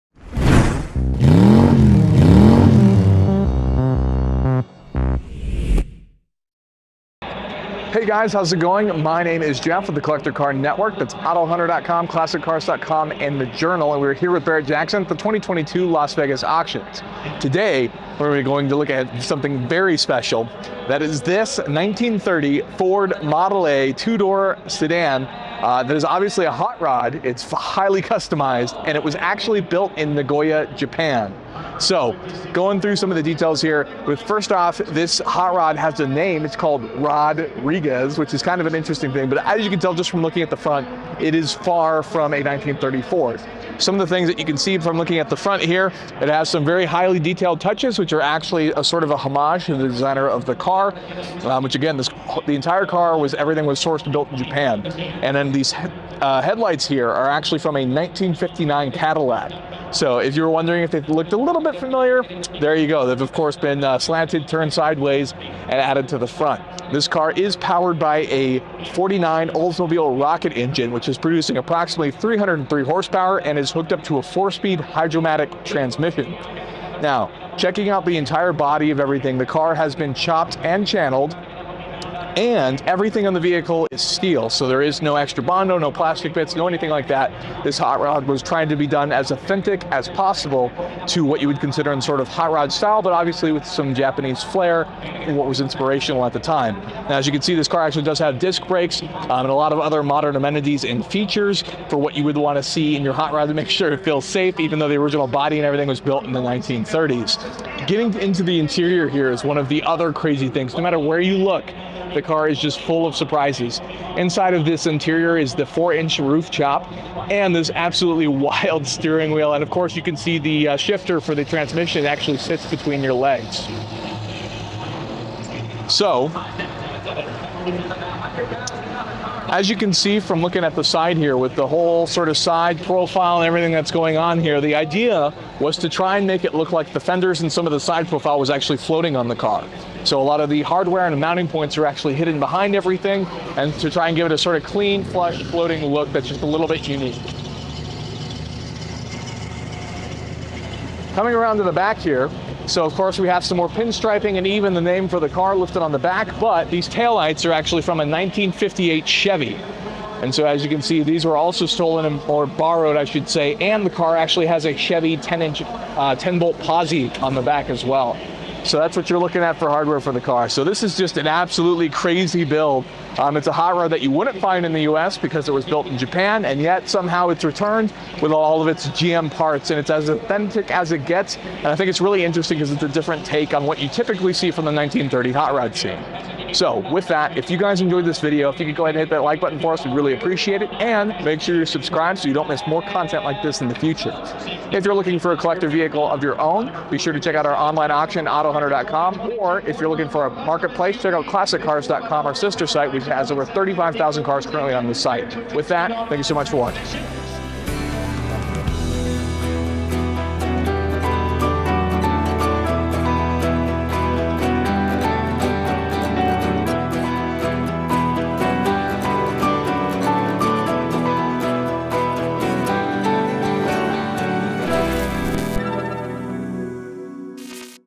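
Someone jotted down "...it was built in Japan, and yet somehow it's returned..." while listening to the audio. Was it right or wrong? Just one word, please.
right.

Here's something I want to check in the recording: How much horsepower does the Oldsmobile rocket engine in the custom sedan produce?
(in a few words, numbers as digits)
303.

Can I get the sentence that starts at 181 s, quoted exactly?
And I think it's really interesting because it's a different take on what you typically see from the 1930 hot rod scene.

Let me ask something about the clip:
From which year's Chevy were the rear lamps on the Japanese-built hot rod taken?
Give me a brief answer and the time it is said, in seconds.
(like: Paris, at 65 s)
1958, at 158 s.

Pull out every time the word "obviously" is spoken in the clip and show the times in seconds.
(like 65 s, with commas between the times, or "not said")
26 s, 93 s.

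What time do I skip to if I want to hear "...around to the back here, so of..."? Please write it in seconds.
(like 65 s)
151 s.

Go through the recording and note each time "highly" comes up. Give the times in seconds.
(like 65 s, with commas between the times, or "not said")
27 s, 46 s.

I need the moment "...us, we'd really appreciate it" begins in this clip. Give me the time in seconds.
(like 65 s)
189 s.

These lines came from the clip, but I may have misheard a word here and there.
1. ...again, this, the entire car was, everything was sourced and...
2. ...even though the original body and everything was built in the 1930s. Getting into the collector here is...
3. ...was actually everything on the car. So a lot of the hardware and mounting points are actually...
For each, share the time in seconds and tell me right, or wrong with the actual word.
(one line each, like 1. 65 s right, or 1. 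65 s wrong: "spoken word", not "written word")
1. 51 s right
2. 104 s wrong: "interior", not "collector"
3. 138 s wrong: "floating", not "everything".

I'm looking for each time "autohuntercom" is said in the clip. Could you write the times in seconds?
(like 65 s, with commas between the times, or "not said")
11 s, 198 s.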